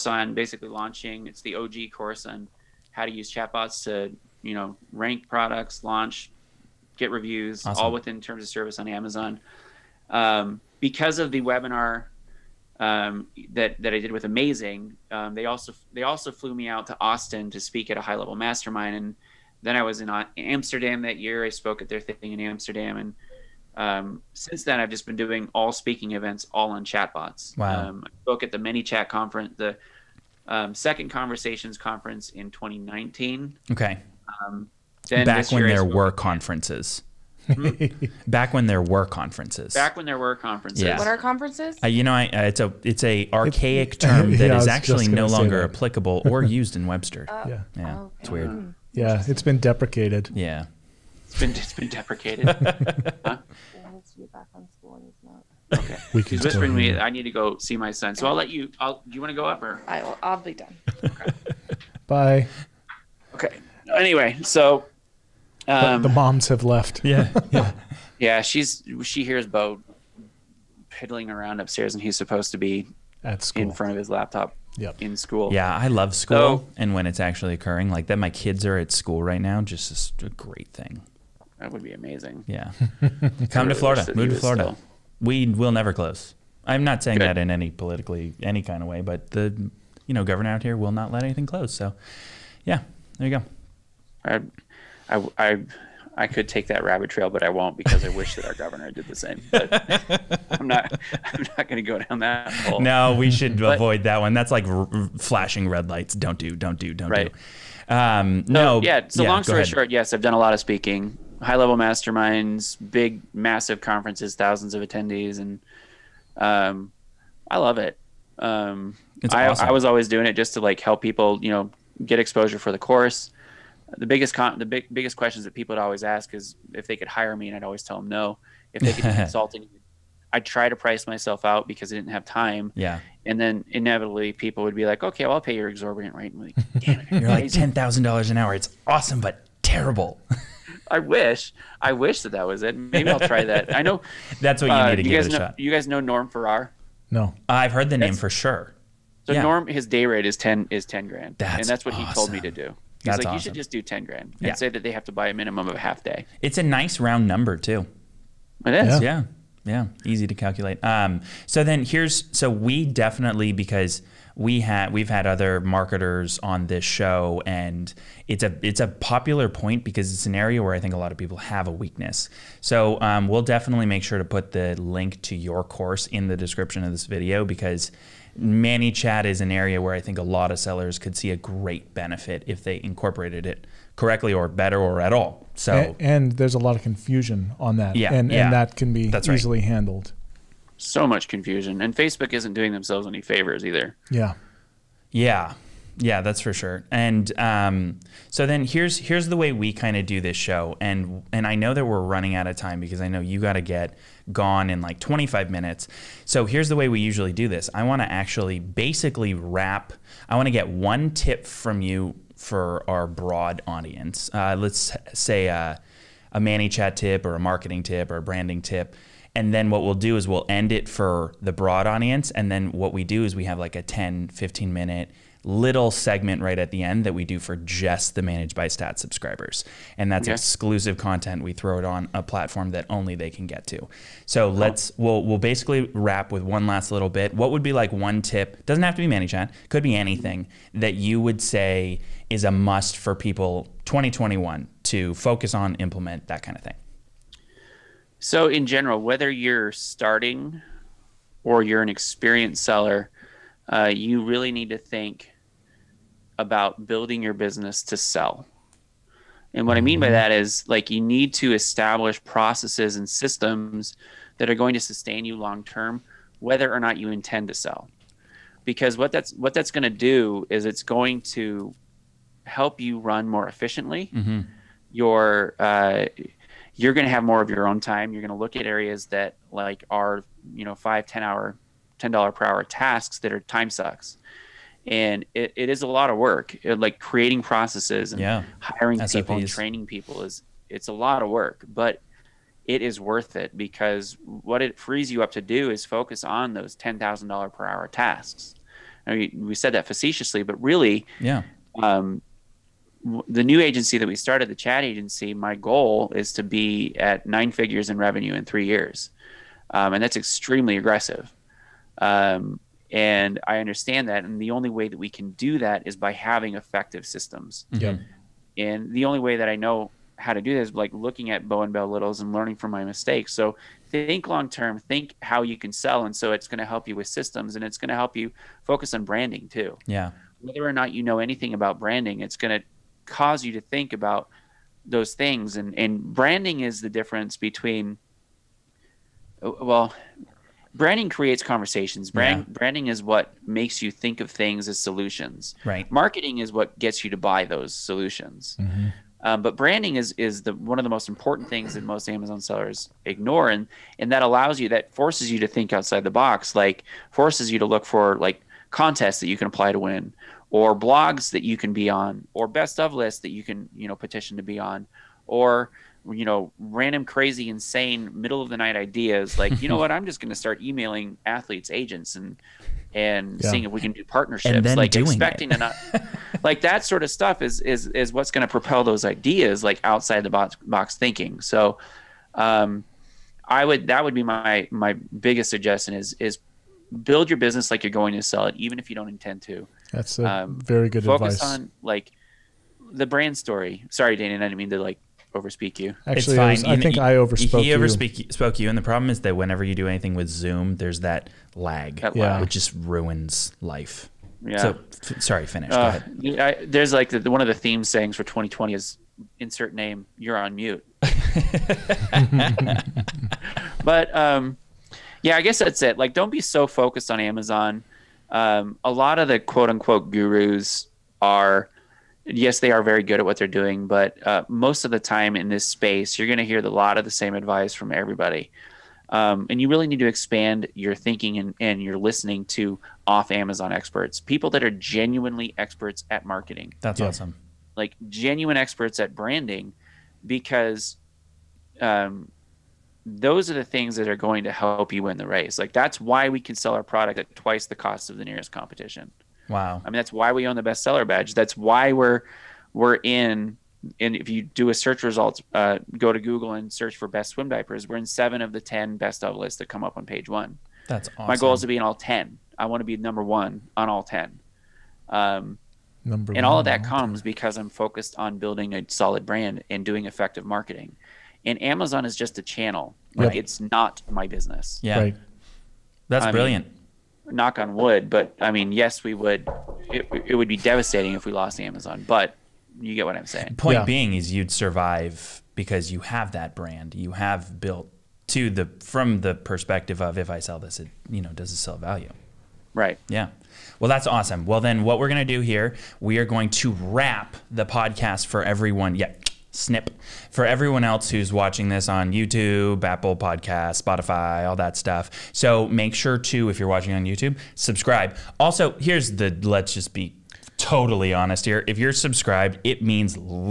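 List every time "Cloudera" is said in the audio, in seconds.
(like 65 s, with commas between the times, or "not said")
not said.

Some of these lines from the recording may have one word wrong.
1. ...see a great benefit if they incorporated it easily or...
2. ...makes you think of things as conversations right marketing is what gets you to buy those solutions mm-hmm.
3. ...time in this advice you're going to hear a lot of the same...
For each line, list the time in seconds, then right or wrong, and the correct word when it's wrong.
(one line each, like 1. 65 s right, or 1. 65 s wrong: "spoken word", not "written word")
1. 181 s wrong: "correctly", not "easily"
2. 343 s wrong: "solutions", not "conversations"
3. 424 s wrong: "space", not "advice".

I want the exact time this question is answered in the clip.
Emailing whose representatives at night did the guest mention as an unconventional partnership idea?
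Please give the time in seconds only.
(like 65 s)
371 s.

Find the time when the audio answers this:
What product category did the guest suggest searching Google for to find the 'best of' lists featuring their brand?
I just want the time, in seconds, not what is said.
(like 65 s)
457 s.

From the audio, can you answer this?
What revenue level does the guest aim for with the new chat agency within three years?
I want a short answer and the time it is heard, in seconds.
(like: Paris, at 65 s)
nine figures, at 307 s.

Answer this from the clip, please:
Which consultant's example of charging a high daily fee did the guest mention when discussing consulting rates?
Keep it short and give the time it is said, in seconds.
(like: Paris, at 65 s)
Norm Farrar, at 146 s.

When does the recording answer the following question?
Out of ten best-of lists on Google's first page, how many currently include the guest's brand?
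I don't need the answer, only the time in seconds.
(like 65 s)
458 s.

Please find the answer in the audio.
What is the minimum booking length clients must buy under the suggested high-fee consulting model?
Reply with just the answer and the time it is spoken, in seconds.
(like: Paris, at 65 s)
half day, at 155 s.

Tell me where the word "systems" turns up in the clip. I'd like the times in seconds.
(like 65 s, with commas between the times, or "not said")
263 s, 317 s, 327 s.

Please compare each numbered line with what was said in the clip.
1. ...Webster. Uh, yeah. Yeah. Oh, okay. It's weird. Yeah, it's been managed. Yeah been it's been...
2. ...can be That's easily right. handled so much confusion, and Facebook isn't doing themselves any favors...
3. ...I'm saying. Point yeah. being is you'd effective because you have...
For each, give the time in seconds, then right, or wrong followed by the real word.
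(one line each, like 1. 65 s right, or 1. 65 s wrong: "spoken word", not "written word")
1. 46 s wrong: "deprecated", not "managed"
2. 188 s right
3. 483 s wrong: "survive", not "effective".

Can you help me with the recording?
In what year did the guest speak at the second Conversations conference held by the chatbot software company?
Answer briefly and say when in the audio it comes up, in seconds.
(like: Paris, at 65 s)
2019, at 32 s.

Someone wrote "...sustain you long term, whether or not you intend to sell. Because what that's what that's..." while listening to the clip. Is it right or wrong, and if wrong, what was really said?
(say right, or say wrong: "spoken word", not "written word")
right.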